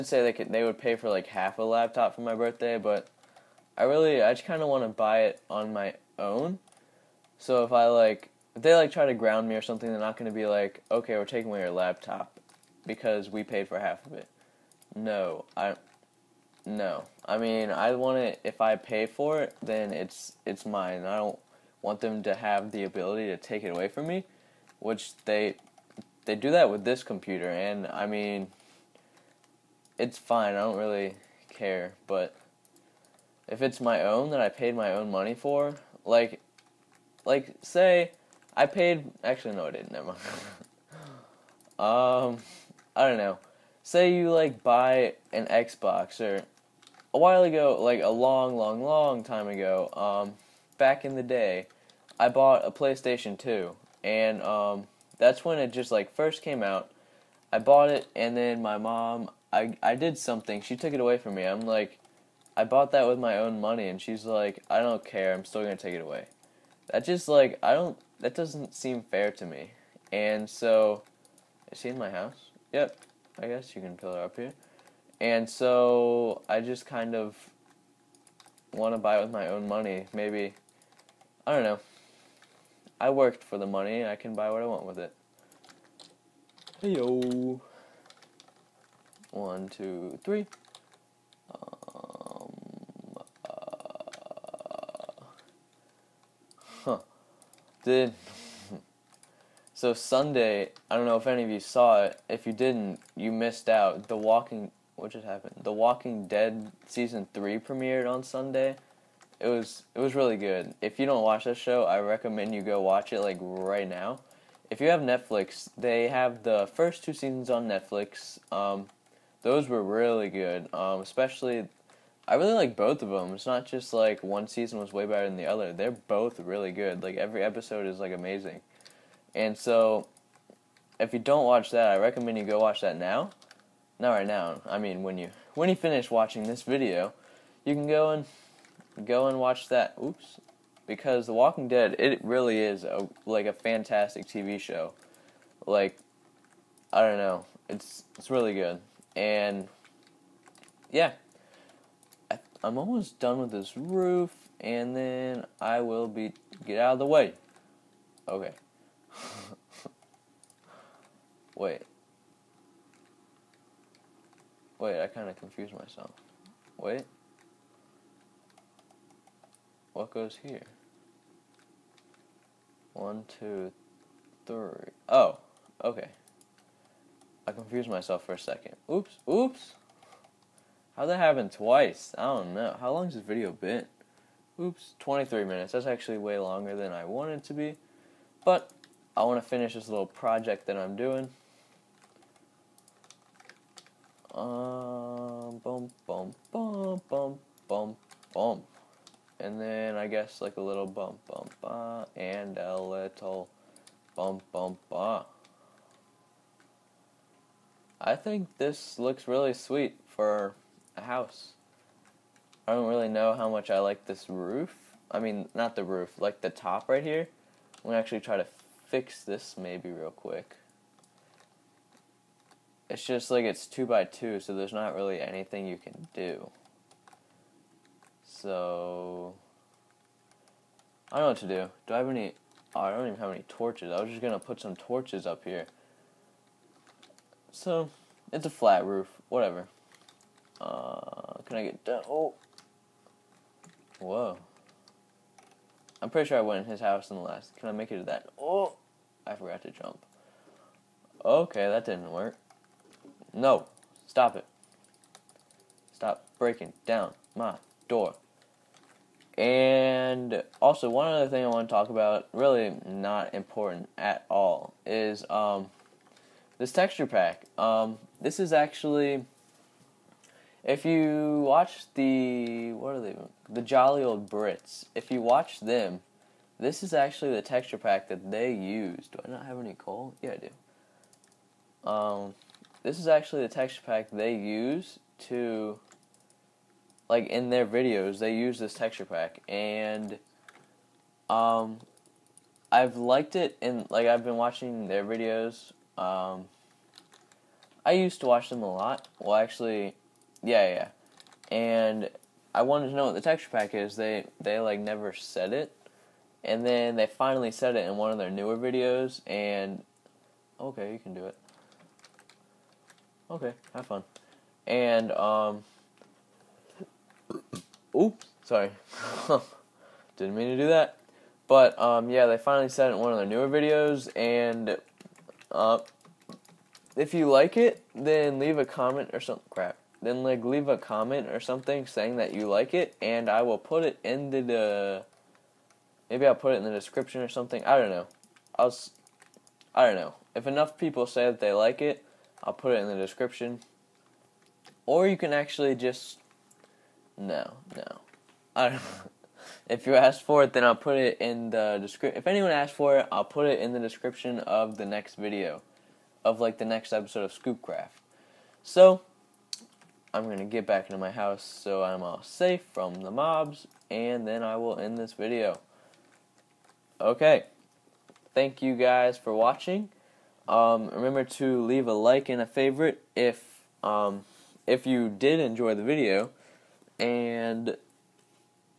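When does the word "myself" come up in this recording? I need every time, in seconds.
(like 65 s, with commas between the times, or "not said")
165 s, 177 s.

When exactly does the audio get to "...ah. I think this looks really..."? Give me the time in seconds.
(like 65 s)
204 s.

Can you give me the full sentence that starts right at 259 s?
And also, one other thing I want to talk about, really not important at all, is um, this texture pack.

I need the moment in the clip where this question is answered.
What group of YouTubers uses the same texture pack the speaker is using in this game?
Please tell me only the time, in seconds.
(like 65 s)
273 s.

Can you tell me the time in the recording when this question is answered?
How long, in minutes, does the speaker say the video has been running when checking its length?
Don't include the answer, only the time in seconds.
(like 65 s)
184 s.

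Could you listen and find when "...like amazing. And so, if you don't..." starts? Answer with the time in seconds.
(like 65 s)
127 s.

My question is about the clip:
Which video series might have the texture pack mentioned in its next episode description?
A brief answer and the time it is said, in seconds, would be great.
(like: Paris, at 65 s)
Scoopcraft, at 357 s.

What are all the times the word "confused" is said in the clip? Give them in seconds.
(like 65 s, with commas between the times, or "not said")
165 s, 177 s.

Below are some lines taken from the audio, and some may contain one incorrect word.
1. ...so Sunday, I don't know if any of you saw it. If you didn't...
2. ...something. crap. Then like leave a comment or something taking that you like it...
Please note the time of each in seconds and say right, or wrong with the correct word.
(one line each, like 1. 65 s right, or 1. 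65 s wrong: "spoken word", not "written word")
1. 99 s right
2. 329 s wrong: "saying", not "taking".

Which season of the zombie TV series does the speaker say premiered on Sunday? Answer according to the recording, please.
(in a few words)
Season 3.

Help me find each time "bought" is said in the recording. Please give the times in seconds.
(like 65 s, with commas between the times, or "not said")
52 s, 57 s, 62 s.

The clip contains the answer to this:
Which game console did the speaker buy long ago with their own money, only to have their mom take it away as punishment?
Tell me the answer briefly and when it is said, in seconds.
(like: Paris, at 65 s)
PlayStation 2, at 52 s.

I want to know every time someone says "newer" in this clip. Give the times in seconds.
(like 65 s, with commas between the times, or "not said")
308 s, 323 s.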